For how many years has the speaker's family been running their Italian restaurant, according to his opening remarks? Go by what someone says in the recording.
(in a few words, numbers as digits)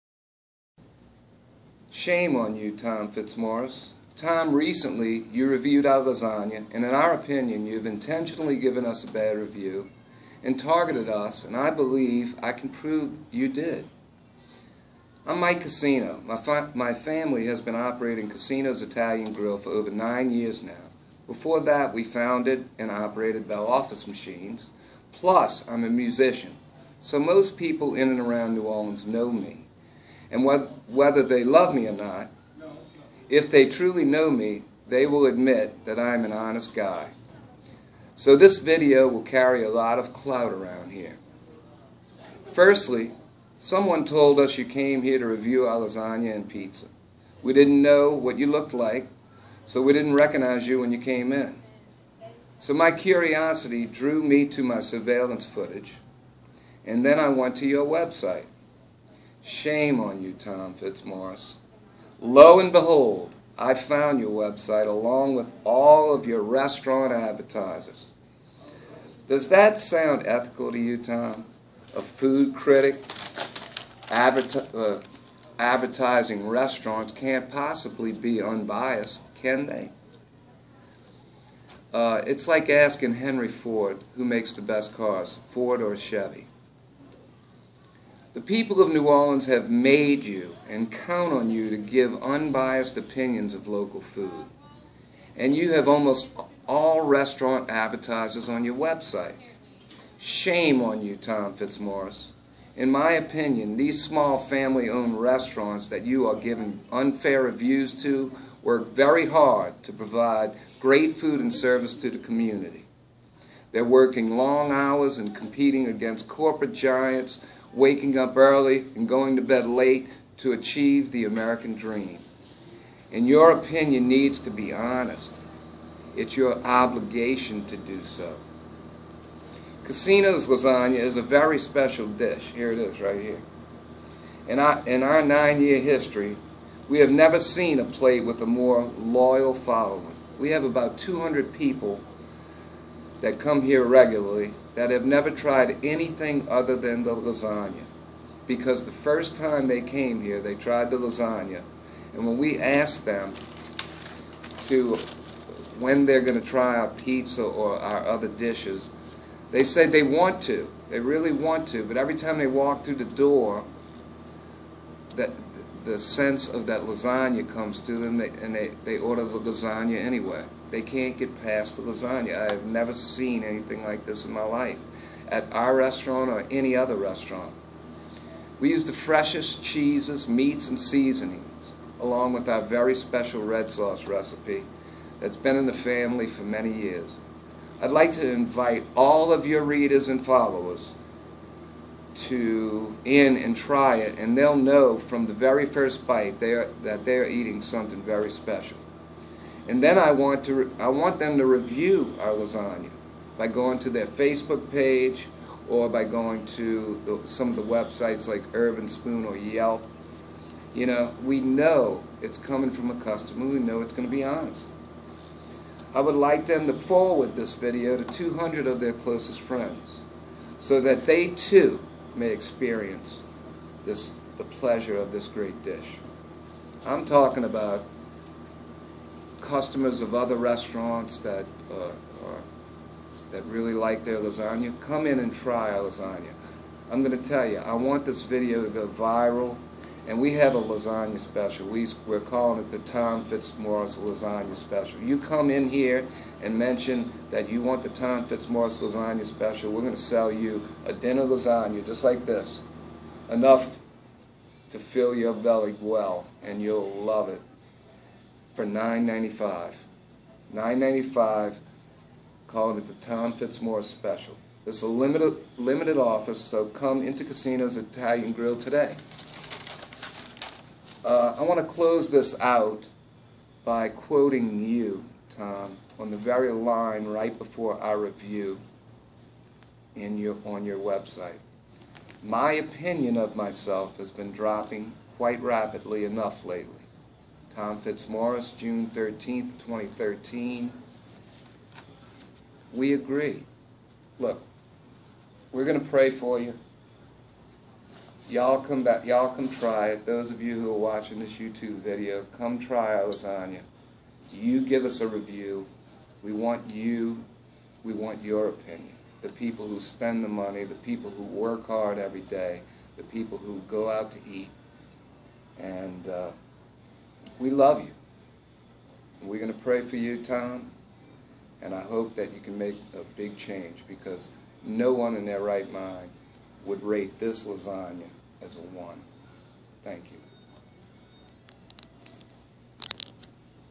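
9.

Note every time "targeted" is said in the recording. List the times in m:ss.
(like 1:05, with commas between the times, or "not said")
0:10.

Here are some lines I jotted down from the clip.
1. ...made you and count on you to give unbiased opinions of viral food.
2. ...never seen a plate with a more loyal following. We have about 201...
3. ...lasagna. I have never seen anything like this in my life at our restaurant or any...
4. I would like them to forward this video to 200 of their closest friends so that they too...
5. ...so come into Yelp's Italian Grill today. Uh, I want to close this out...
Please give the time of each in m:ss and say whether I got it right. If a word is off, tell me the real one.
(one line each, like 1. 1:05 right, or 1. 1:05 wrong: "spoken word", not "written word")
1. 1:29 wrong: "local", not "viral"
2. 2:17 wrong: "200", not "201"
3. 2:51 right
4. 3:35 right
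5. 4:26 wrong: "Coscino", not "Yelp".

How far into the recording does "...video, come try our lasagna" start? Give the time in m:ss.
5:01.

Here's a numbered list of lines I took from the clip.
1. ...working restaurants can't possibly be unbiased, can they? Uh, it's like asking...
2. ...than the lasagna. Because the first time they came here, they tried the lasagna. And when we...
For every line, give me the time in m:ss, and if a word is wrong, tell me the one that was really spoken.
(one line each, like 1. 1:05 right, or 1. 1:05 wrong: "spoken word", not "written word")
1. 1:15 wrong: "advertising", not "working"
2. 2:26 right.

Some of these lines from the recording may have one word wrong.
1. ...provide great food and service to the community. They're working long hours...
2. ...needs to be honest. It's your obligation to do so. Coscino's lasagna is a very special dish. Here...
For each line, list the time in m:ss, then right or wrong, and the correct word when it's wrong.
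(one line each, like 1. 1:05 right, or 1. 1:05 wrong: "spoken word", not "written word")
1. 1:49 right
2. 2:04 right.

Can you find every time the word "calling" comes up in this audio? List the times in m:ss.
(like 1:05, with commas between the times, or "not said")
4:02, 4:22.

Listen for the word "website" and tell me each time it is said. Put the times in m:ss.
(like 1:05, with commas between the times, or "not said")
0:57, 1:04, 1:38, 3:27, 4:40.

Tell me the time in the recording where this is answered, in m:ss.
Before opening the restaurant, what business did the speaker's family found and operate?
0:23.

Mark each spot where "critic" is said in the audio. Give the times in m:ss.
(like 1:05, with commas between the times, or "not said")
1:12.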